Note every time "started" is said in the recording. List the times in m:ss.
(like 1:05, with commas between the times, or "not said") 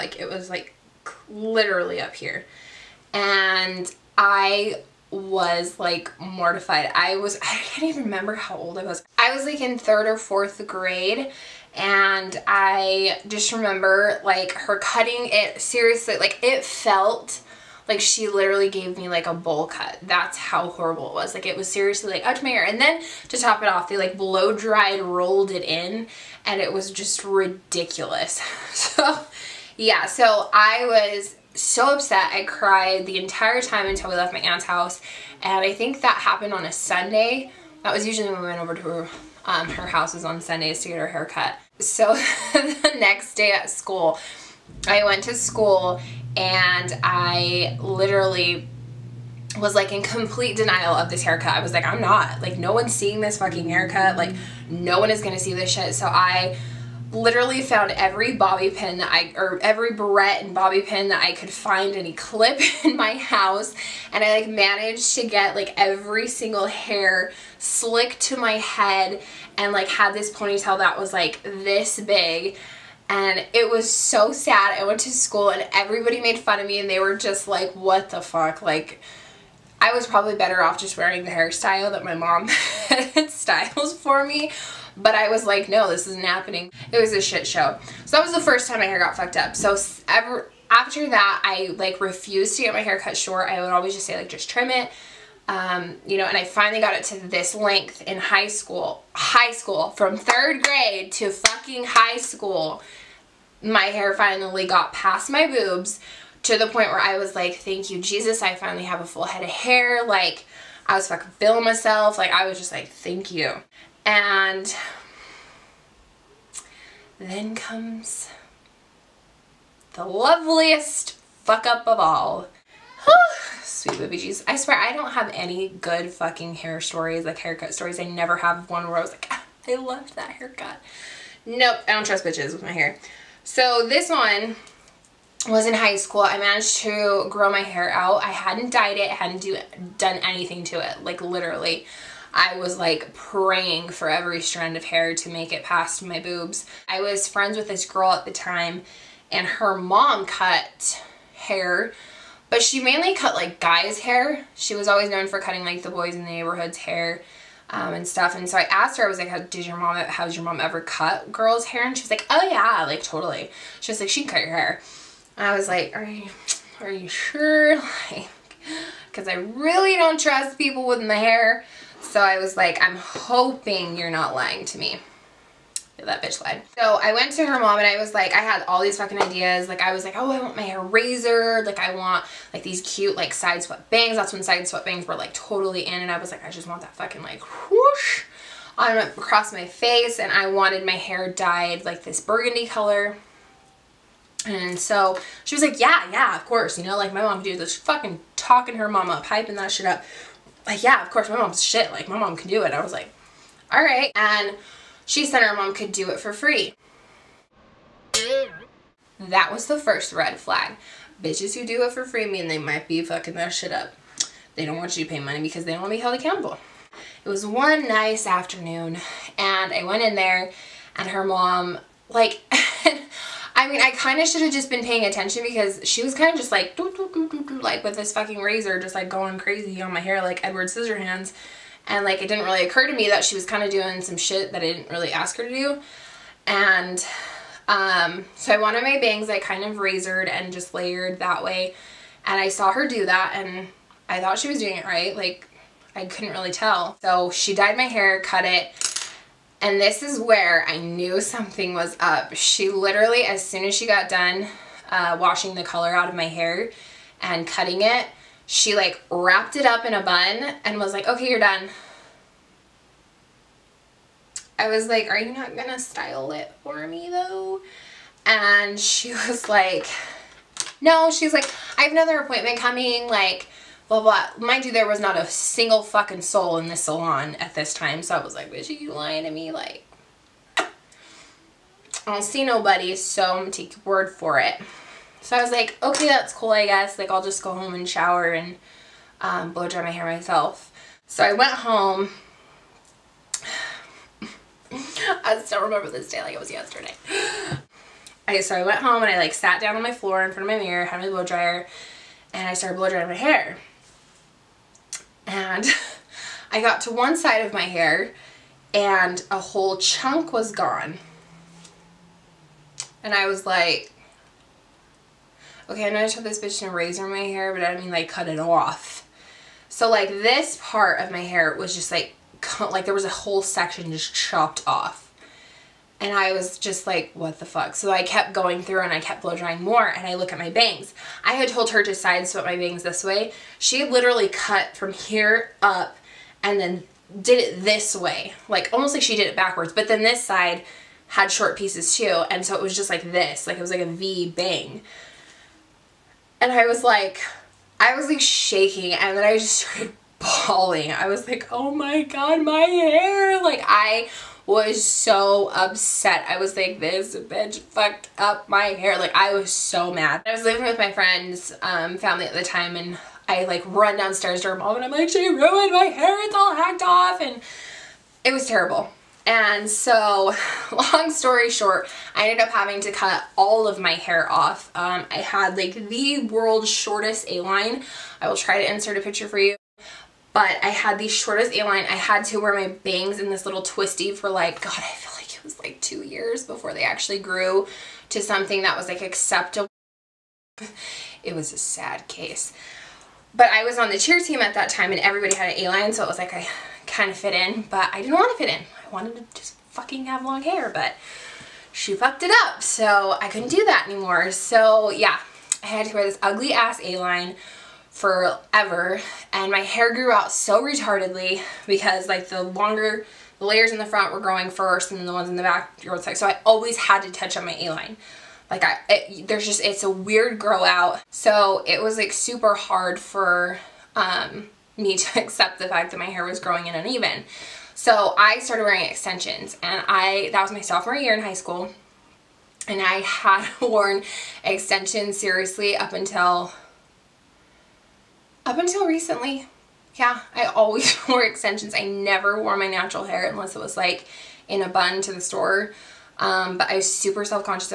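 5:02, 5:49, 7:08.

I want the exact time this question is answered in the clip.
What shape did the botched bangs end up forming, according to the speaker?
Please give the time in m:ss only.
5:43.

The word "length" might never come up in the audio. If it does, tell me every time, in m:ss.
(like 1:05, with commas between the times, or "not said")
1:37.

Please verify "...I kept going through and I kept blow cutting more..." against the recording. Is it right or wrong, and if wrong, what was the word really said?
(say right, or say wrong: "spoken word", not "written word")
wrong: "drying", not "cutting".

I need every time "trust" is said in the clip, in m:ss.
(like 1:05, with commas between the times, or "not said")
2:12, 2:50.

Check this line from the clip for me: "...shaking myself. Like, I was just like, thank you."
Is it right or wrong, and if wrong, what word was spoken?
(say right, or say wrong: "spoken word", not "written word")
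wrong: "feeling", not "shaking".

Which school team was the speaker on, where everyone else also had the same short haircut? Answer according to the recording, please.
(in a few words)
cheer team.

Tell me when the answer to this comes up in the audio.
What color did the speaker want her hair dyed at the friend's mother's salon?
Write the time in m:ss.
3:12.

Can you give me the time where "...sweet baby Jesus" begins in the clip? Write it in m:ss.
2:03.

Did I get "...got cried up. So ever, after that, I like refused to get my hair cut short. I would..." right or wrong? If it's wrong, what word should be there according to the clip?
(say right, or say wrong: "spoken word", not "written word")
wrong: "fucked", not "cried".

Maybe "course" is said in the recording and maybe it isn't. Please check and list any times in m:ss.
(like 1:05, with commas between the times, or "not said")
3:16, 3:21.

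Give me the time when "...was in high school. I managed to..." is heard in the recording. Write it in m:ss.
2:15.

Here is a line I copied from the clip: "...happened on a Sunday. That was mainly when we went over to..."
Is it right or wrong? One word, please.
wrong.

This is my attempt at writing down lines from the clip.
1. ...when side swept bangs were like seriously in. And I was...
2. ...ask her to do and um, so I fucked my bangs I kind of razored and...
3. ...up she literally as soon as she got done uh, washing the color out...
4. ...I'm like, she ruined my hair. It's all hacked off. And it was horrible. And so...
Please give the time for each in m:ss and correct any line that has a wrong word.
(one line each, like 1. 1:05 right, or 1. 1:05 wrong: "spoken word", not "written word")
1. 3:04 wrong: "totally", not "seriously"
2. 3:55 wrong: "wanted", not "fucked"
3. 4:11 right
4. 6:04 wrong: "terrible", not "horrible".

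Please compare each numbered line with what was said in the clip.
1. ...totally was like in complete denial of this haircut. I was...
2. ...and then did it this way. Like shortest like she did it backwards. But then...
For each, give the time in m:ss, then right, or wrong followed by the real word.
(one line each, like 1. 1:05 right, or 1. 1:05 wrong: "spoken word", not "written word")
1. 0:47 wrong: "literally", not "totally"
2. 5:36 wrong: "almost", not "shortest".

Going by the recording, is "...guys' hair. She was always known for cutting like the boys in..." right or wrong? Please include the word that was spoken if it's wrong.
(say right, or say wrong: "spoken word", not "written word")
right.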